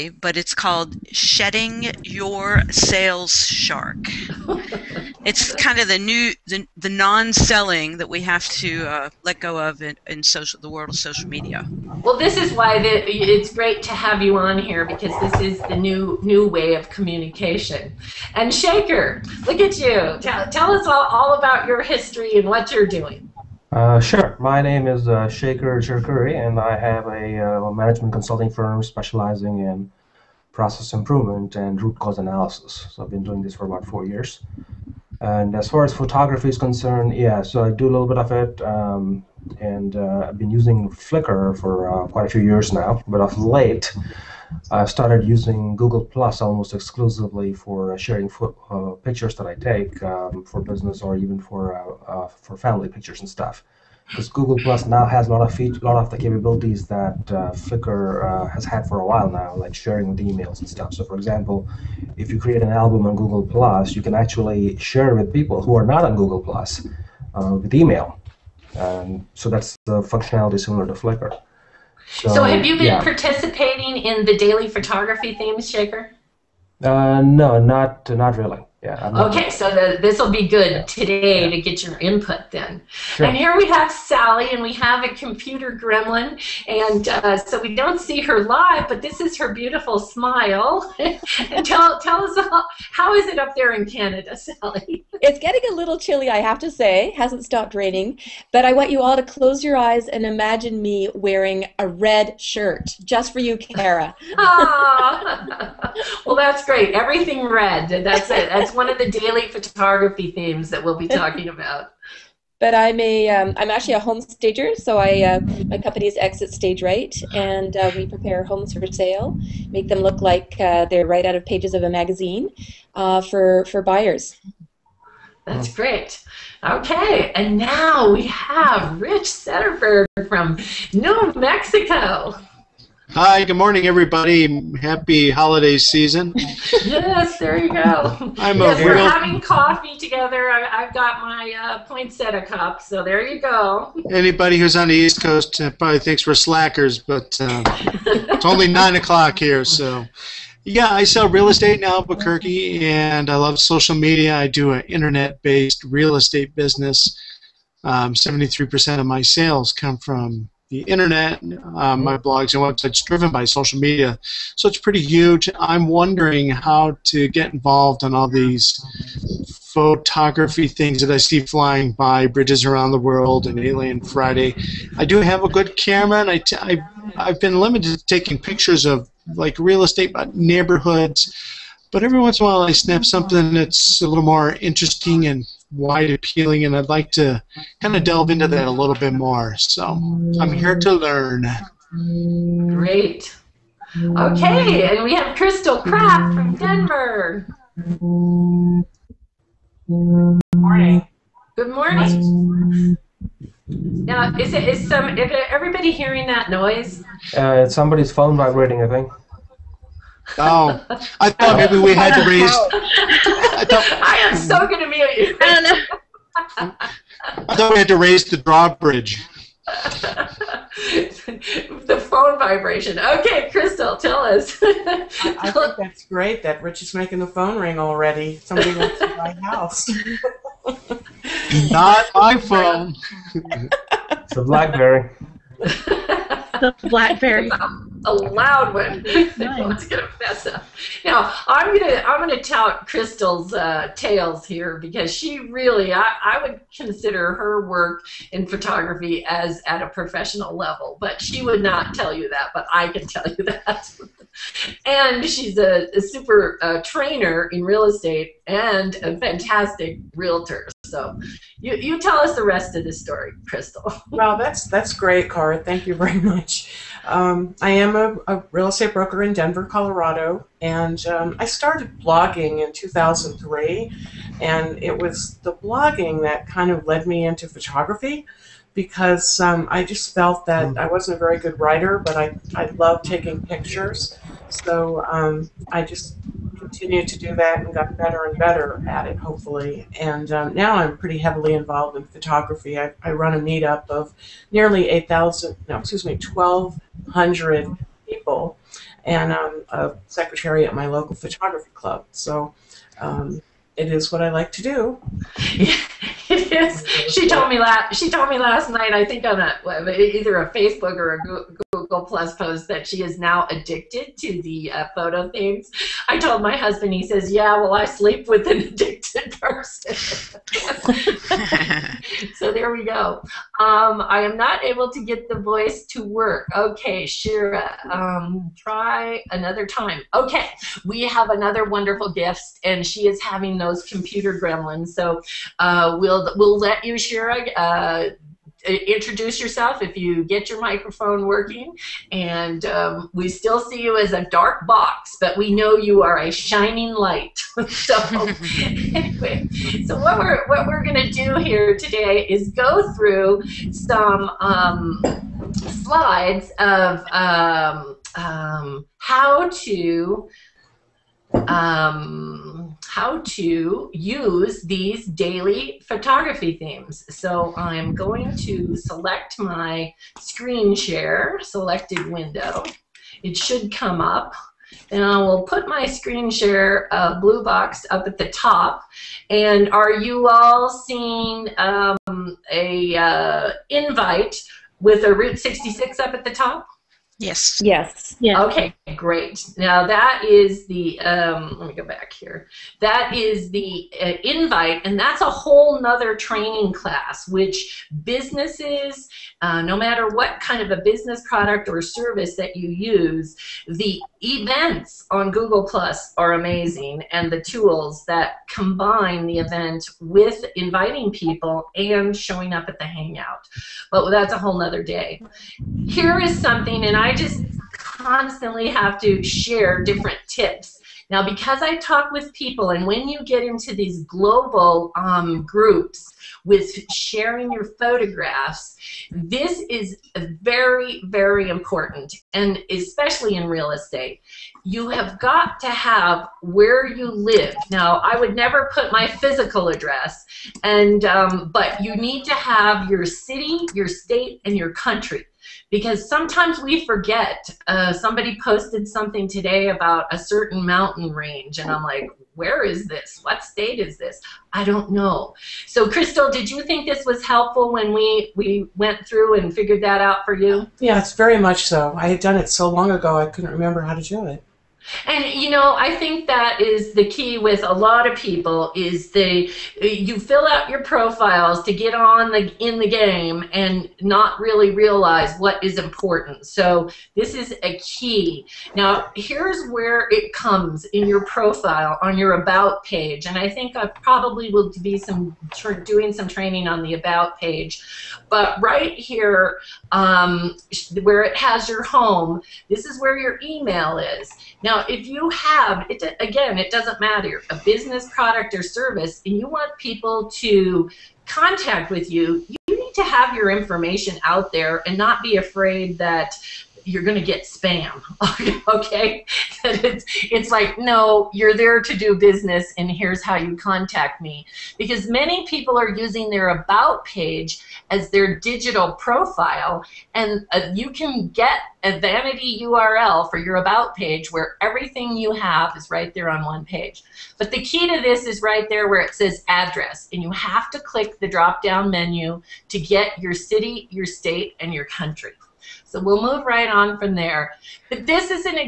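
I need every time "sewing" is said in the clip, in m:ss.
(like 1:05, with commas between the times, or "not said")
not said.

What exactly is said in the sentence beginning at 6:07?
So I'm going to select my screen share, selected window.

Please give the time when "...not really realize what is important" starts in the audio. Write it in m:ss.
7:54.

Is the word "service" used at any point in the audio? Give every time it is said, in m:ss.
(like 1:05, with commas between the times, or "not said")
6:41, 8:18.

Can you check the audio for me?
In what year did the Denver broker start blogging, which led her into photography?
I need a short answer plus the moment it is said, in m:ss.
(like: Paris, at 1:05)
2003, at 4:32.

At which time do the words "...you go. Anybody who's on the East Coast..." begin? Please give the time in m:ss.
2:23.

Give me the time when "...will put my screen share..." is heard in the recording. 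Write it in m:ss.
6:15.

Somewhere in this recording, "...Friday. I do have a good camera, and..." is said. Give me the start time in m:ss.
2:54.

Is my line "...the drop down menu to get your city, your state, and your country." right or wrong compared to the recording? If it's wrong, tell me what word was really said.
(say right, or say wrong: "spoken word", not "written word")
right.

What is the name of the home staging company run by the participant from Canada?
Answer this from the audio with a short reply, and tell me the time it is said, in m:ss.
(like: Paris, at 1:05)
Exit Stage Right, at 1:56.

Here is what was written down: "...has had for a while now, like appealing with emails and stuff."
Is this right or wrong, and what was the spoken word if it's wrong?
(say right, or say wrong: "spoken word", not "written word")
wrong: "sharing", not "appealing".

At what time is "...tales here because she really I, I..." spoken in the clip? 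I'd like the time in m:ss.
4:03.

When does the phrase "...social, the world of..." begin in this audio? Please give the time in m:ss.
0:10.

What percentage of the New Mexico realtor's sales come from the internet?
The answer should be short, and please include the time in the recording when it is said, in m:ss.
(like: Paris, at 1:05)
73%, at 2:38.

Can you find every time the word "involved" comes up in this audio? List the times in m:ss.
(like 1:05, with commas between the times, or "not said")
2:47, 4:51.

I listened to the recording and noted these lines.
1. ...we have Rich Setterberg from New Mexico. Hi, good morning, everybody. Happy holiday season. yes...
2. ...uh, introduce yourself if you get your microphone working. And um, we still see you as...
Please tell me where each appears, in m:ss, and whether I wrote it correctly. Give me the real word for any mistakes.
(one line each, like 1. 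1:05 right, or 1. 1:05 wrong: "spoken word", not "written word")
1. 2:08 right
2. 5:37 right.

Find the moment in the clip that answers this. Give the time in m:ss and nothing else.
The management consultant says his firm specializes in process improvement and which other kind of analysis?
0:31.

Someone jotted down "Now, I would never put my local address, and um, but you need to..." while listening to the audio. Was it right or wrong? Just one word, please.
wrong.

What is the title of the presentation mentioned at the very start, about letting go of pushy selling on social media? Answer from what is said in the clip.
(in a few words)
Shedding Your Sales Shark.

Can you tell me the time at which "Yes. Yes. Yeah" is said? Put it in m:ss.
6:27.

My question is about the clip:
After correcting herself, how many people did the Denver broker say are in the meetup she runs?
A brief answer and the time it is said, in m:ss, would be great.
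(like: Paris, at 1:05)
1,200, at 4:56.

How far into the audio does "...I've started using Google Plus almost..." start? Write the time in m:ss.
0:44.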